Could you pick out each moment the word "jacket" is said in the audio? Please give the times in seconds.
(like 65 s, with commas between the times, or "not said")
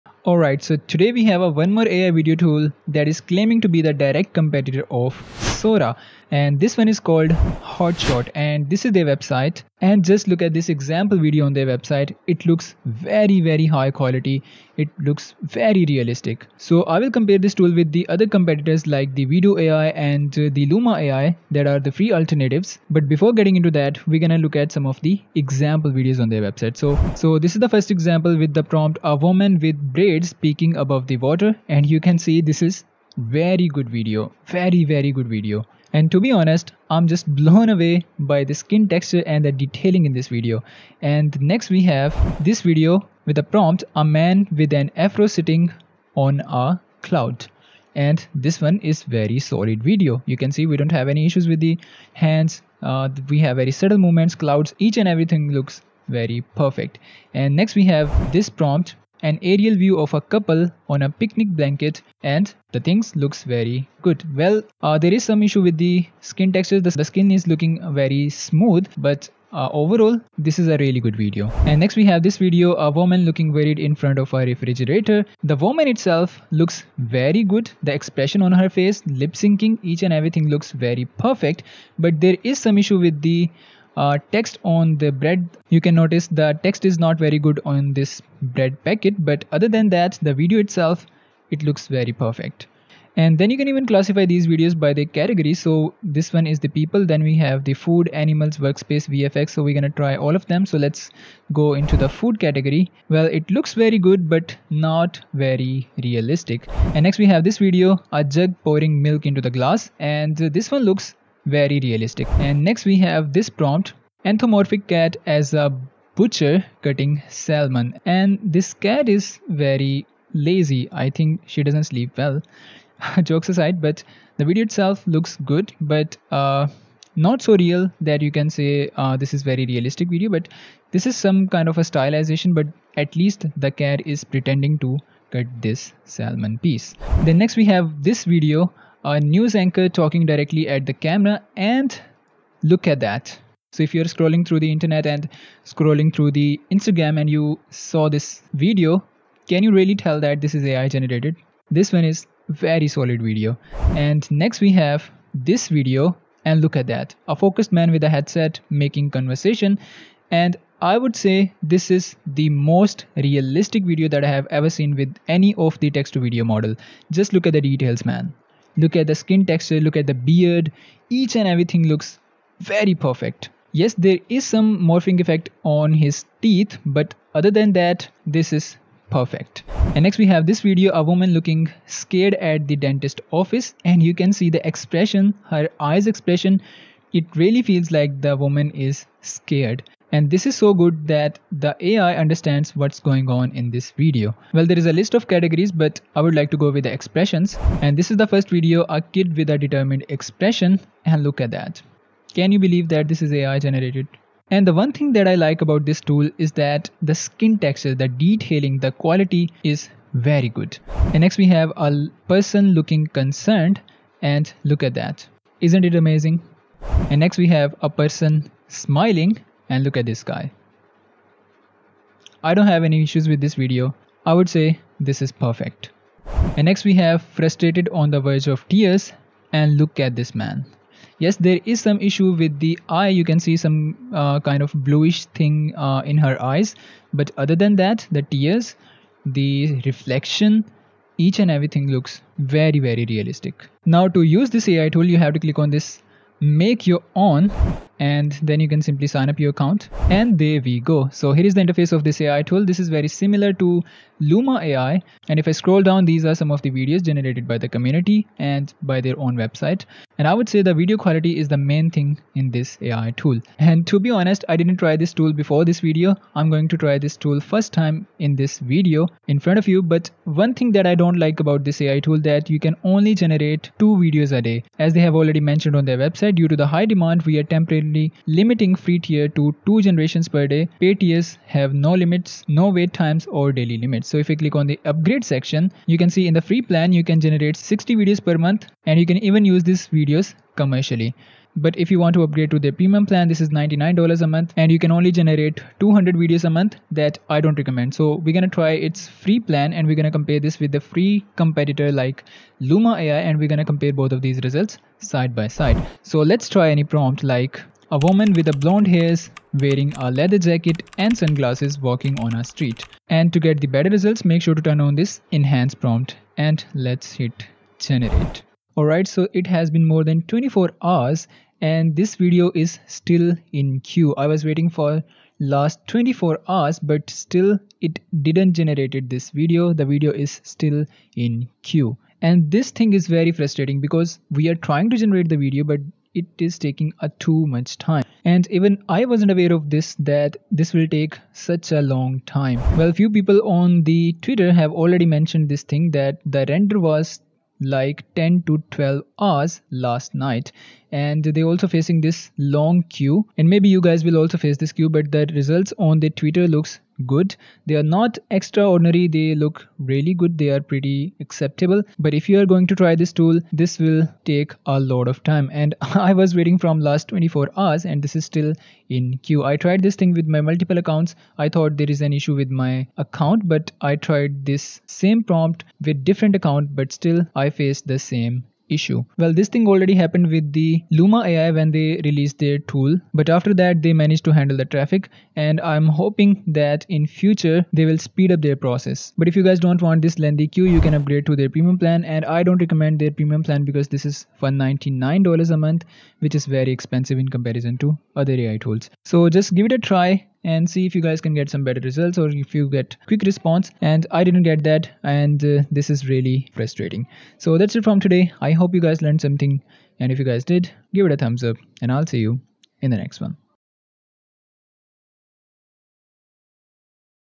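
310 s.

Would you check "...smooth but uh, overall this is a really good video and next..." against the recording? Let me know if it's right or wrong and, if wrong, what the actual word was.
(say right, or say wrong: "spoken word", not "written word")
right.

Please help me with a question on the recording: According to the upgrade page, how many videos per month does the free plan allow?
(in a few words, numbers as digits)
60.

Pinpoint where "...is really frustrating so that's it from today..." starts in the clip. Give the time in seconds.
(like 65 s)
405 s.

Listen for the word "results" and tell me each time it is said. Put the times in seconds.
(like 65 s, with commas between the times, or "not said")
304 s, 313 s, 355 s, 401 s.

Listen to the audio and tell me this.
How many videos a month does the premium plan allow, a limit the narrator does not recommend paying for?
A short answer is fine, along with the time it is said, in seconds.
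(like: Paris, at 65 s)
200, at 295 s.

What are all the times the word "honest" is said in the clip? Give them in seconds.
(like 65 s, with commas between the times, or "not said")
36 s, 264 s.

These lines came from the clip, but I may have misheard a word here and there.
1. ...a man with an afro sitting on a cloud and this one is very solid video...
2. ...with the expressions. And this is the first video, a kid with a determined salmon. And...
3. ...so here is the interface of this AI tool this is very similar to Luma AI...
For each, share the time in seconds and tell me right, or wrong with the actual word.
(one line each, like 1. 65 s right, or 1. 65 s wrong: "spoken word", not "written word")
1. 43 s right
2. 196 s wrong: "expression", not "salmon"
3. 251 s right.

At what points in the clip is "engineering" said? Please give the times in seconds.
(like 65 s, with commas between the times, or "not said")
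not said.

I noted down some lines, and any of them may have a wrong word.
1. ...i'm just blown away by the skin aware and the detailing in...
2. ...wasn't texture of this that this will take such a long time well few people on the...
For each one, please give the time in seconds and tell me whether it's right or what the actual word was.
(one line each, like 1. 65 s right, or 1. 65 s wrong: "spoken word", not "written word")
1. 36 s wrong: "texture", not "aware"
2. 339 s wrong: "aware", not "texture".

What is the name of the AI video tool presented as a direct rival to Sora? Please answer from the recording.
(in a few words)
Hotshot.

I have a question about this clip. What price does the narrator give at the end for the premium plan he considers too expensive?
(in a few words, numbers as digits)
$199 a month.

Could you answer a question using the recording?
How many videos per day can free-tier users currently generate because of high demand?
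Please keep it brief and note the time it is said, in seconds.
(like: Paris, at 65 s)
2, at 279 s.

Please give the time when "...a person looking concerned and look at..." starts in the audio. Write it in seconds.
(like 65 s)
211 s.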